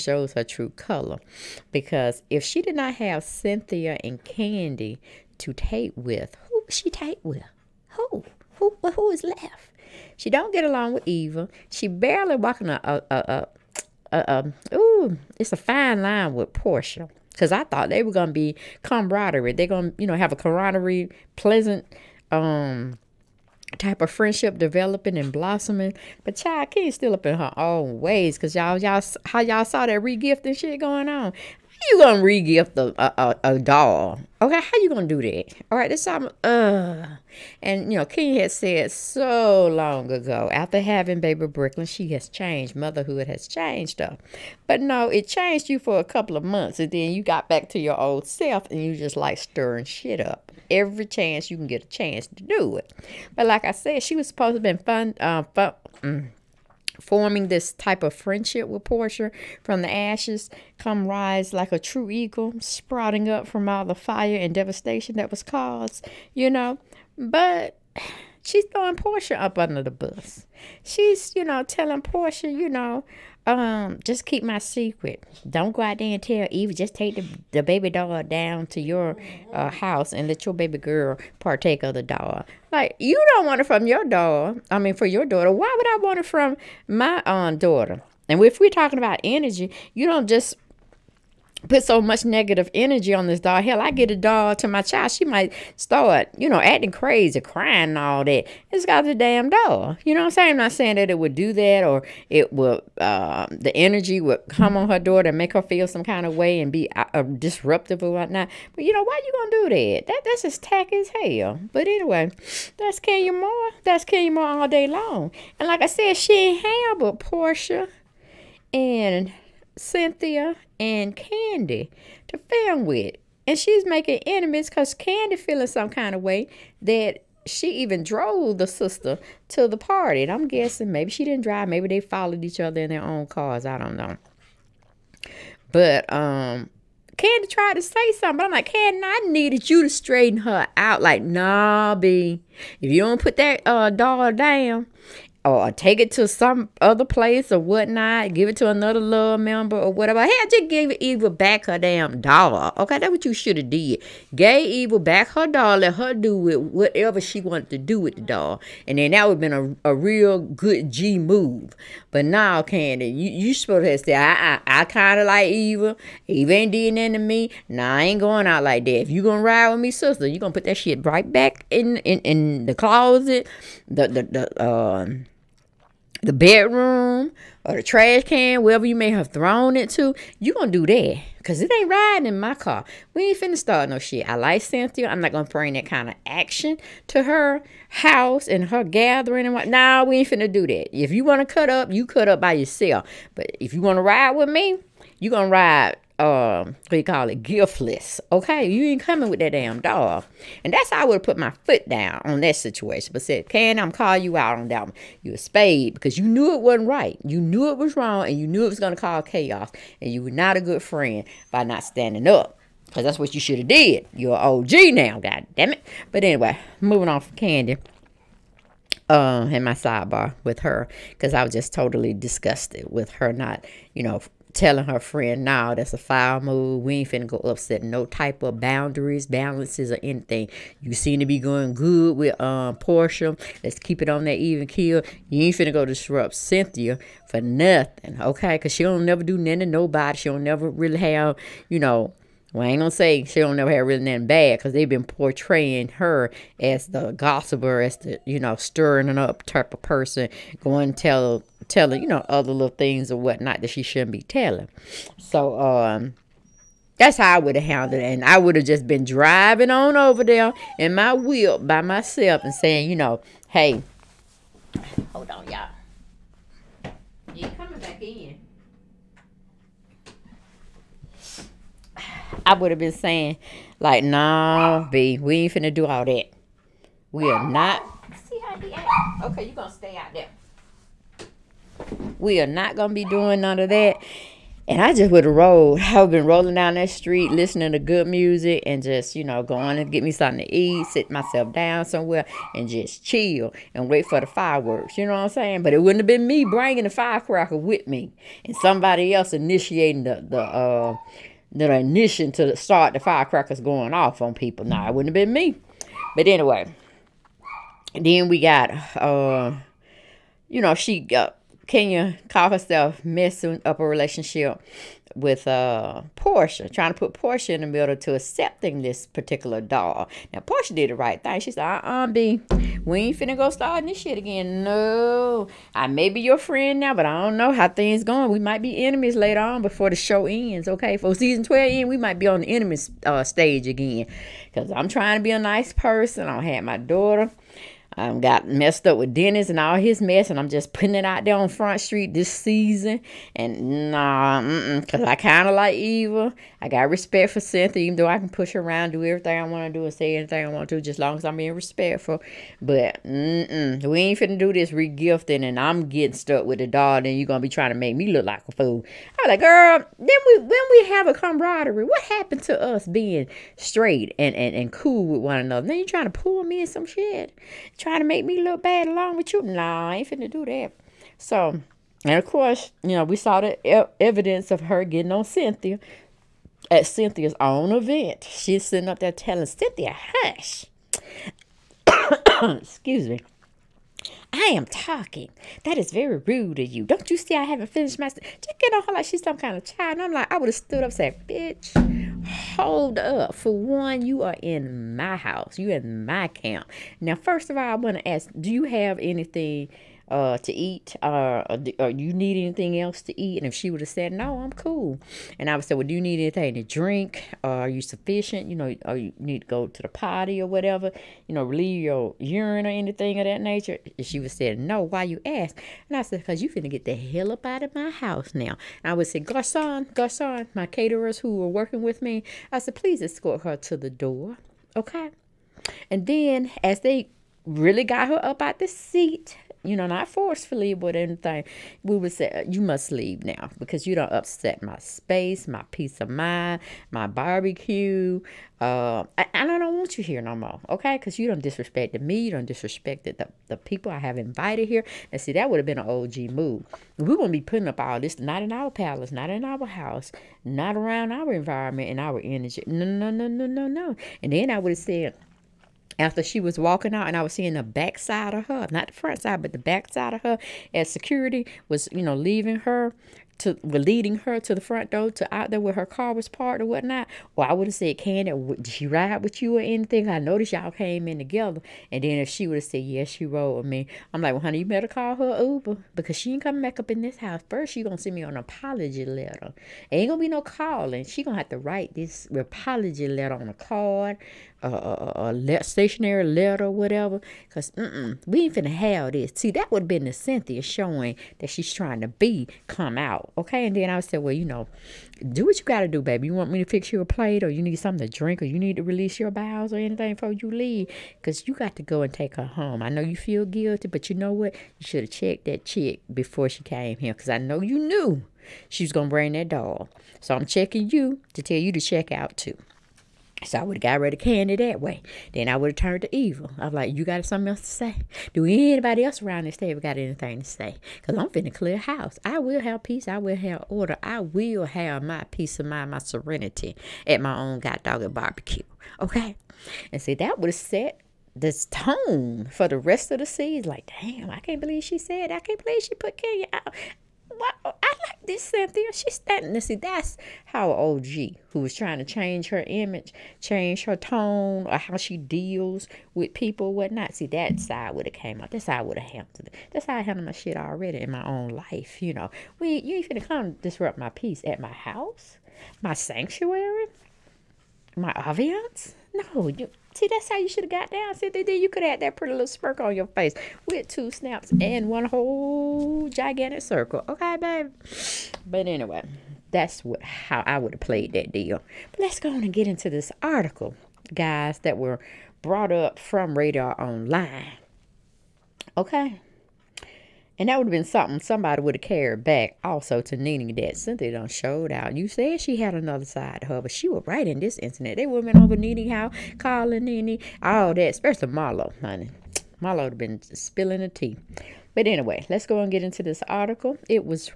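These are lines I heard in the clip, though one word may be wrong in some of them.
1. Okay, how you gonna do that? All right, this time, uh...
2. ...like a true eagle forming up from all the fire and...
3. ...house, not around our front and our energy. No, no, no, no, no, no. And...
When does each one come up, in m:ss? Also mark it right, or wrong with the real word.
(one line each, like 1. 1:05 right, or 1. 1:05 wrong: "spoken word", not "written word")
1. 0:34 right
2. 1:01 wrong: "sprouting", not "forming"
3. 7:29 wrong: "environment", not "front".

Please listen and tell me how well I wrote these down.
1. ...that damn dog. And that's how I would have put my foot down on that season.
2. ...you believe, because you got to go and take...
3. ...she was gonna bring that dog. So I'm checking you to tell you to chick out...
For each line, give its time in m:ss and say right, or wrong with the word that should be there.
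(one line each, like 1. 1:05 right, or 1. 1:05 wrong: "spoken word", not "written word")
1. 3:19 wrong: "situation", not "season"
2. 8:20 wrong: "leave", not "believe"
3. 8:28 wrong: "check", not "chick".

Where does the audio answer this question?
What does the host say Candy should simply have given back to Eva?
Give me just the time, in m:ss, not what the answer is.
2:30.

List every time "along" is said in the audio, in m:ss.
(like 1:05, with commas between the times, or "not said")
0:10, 6:08.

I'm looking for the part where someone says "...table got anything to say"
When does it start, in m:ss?
8:39.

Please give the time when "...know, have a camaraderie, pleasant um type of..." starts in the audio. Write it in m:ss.
0:20.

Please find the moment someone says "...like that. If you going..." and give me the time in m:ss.
2:48.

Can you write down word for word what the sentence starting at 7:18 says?
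Uh, I, I don't want you here no more, okay?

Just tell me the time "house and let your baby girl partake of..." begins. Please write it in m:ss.
1:19.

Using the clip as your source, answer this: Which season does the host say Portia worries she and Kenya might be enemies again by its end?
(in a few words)
Season 12.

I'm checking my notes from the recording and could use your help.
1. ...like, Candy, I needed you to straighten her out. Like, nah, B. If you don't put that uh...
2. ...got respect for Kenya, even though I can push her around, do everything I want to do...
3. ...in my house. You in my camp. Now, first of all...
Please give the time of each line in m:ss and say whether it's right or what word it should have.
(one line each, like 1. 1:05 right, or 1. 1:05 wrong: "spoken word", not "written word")
1. 2:18 right
2. 5:46 wrong: "Cynthia", not "Kenya"
3. 6:34 right.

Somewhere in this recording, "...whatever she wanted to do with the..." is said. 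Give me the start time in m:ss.
2:36.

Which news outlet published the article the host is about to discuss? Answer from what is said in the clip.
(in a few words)
Radar Online.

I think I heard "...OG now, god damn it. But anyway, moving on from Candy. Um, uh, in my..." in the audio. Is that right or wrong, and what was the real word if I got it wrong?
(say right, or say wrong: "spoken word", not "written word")
right.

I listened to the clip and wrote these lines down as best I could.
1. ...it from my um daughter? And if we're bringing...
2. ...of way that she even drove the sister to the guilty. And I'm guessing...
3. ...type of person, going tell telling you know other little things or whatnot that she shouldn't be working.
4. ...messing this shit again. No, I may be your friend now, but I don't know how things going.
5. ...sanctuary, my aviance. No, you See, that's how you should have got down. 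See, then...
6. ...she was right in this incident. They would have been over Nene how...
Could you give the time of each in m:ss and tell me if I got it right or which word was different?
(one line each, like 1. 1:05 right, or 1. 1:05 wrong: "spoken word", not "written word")
1. 1:26 wrong: "talking", not "bringing"
2. 2:06 wrong: "party", not "guilty"
3. 4:09 wrong: "telling", not "working"
4. 5:23 wrong: "starting", not "messing"
5. 9:15 right
6. 9:46 right.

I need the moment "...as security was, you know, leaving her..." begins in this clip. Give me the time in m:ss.
7:40.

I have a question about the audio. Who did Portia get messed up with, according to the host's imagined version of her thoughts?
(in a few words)
Dennis.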